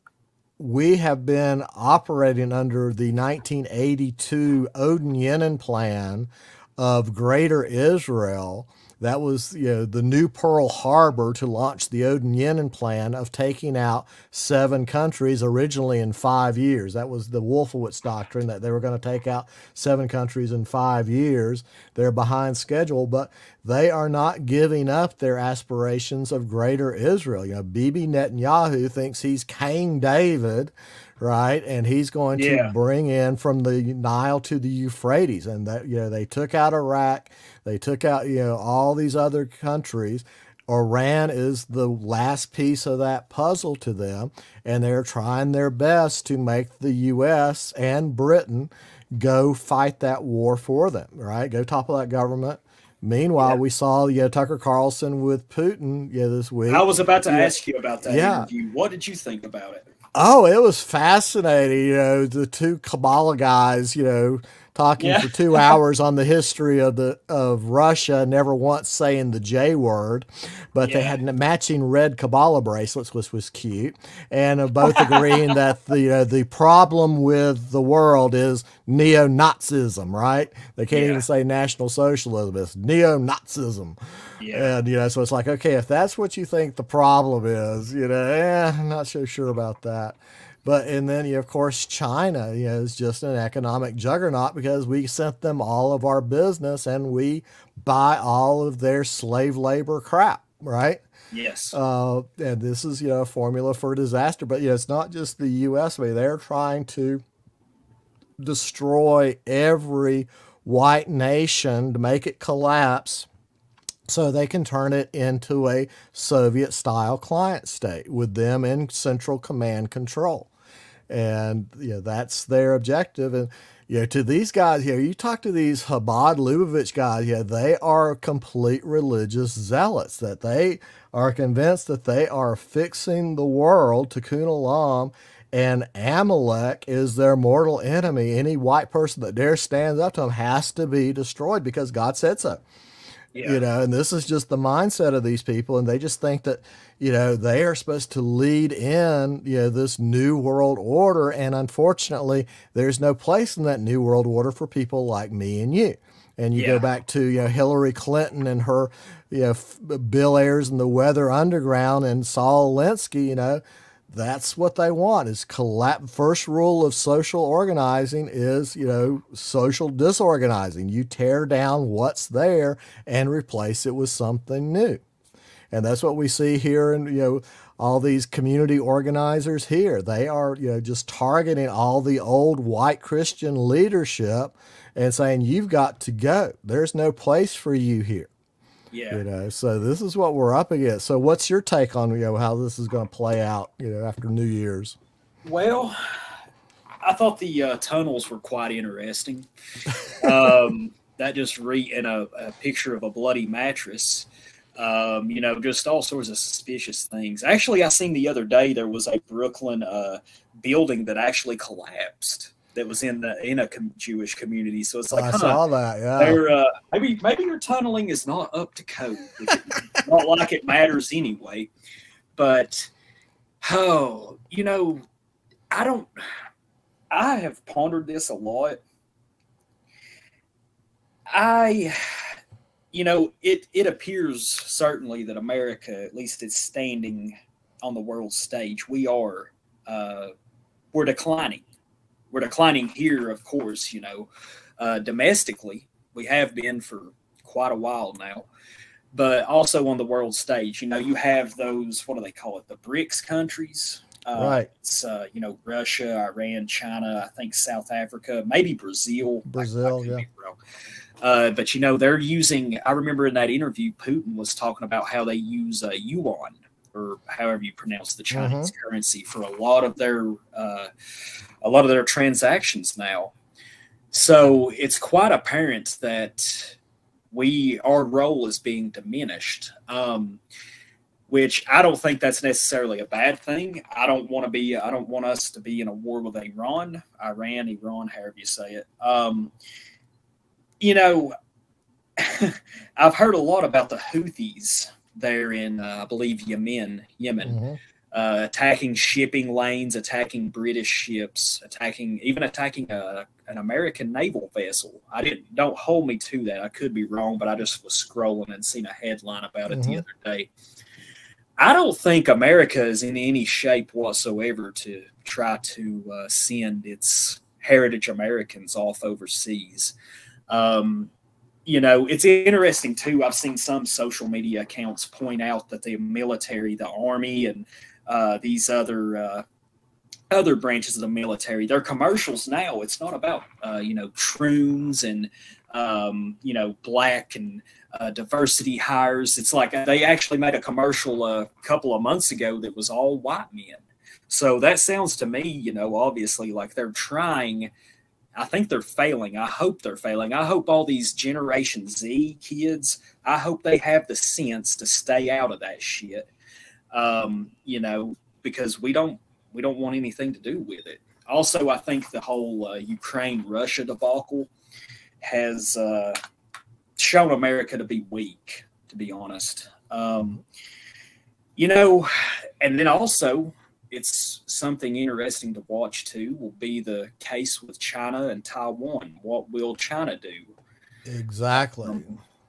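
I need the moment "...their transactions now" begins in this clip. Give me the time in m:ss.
4:31.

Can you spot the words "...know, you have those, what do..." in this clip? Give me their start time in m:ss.
4:10.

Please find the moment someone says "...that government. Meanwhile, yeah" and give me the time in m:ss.
0:51.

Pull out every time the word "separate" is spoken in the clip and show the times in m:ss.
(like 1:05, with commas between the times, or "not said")
not said.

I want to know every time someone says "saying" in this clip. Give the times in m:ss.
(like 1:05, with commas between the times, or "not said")
1:08, 3:05.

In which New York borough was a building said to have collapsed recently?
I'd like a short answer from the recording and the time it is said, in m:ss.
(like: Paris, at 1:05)
Brooklyn, at 3:29.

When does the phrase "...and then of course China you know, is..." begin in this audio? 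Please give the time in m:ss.
1:30.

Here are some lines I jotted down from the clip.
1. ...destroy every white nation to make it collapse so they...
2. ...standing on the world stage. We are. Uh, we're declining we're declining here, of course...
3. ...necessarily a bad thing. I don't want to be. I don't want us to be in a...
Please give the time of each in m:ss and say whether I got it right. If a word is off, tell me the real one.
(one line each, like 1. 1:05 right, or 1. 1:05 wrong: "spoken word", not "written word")
1. 1:48 right
2. 3:56 right
3. 4:42 right.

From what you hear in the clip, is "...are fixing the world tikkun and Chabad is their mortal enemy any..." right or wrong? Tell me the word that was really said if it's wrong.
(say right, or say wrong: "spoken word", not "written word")
wrong: "Amalek", not "Chabad".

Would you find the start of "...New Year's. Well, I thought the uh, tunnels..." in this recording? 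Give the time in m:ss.
3:14.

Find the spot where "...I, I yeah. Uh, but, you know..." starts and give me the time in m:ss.
4:20.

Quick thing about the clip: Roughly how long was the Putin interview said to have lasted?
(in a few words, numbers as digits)
2 hours.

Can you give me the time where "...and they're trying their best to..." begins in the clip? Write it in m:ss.
0:44.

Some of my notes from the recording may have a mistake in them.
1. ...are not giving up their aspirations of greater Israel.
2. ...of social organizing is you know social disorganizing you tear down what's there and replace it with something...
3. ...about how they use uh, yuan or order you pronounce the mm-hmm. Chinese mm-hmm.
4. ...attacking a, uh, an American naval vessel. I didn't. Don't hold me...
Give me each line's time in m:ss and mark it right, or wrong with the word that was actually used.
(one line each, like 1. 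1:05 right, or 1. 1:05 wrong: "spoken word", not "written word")
1. 0:23 right
2. 2:46 right
3. 4:24 wrong: "however", not "order"
4. 5:02 right.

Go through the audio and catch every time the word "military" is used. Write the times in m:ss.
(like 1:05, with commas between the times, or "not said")
5:25, 5:31.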